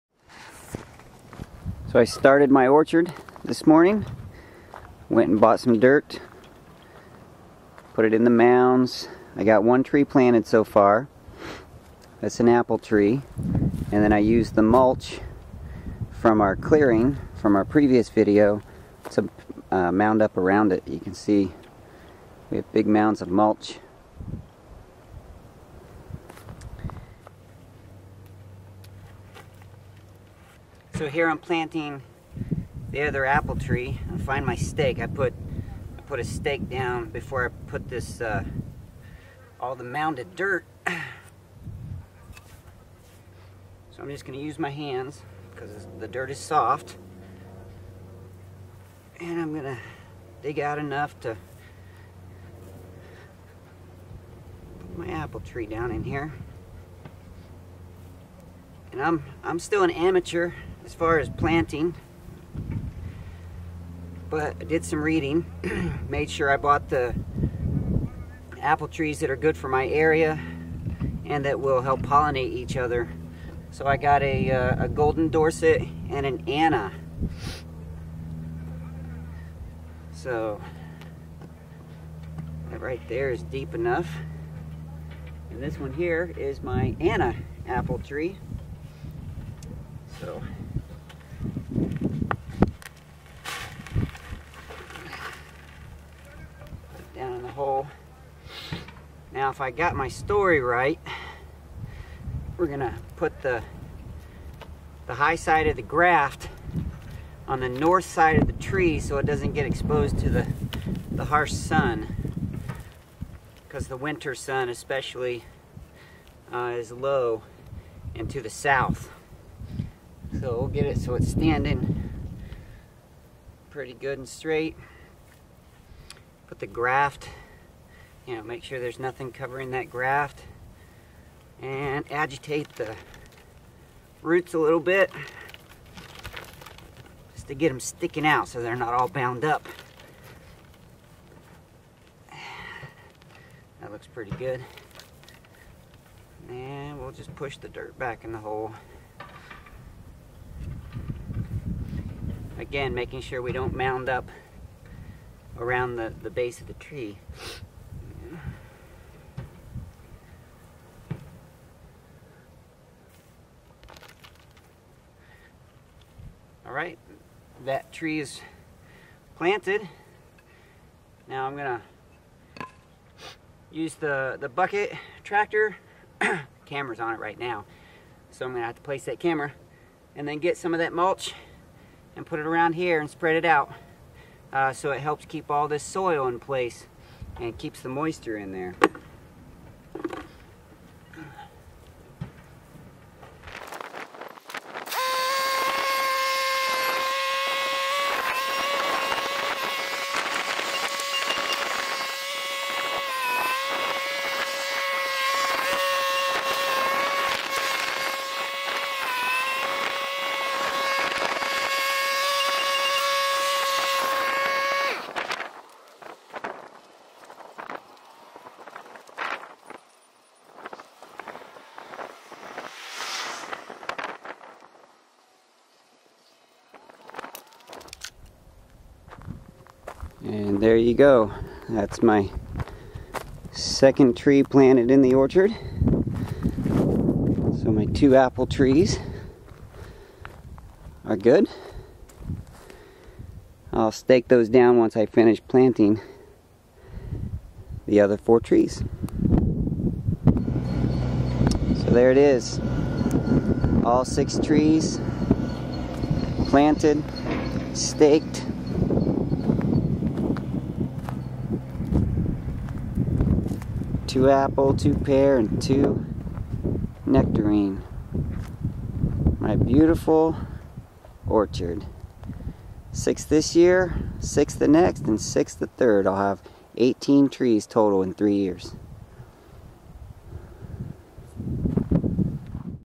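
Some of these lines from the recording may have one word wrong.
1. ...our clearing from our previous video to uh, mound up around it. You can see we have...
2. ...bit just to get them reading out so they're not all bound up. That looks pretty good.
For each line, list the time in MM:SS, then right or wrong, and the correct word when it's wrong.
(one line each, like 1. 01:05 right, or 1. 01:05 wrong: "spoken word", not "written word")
1. 00:16 right
2. 02:14 wrong: "sticking", not "reading".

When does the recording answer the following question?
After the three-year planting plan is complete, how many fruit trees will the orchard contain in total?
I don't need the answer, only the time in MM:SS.
04:36.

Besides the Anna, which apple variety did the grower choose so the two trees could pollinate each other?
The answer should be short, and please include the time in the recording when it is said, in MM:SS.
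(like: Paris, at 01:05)
Golden Dorset, at 01:14.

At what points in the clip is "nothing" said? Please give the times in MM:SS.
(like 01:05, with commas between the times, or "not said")
02:08.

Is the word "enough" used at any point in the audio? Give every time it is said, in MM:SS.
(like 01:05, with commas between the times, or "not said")
00:50, 01:23.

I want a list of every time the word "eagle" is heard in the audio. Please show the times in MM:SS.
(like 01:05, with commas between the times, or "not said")
not said.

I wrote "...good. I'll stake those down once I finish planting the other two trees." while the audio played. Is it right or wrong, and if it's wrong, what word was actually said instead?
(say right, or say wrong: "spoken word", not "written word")
wrong: "four", not "two".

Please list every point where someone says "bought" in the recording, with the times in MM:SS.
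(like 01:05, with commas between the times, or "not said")
00:05, 01:06.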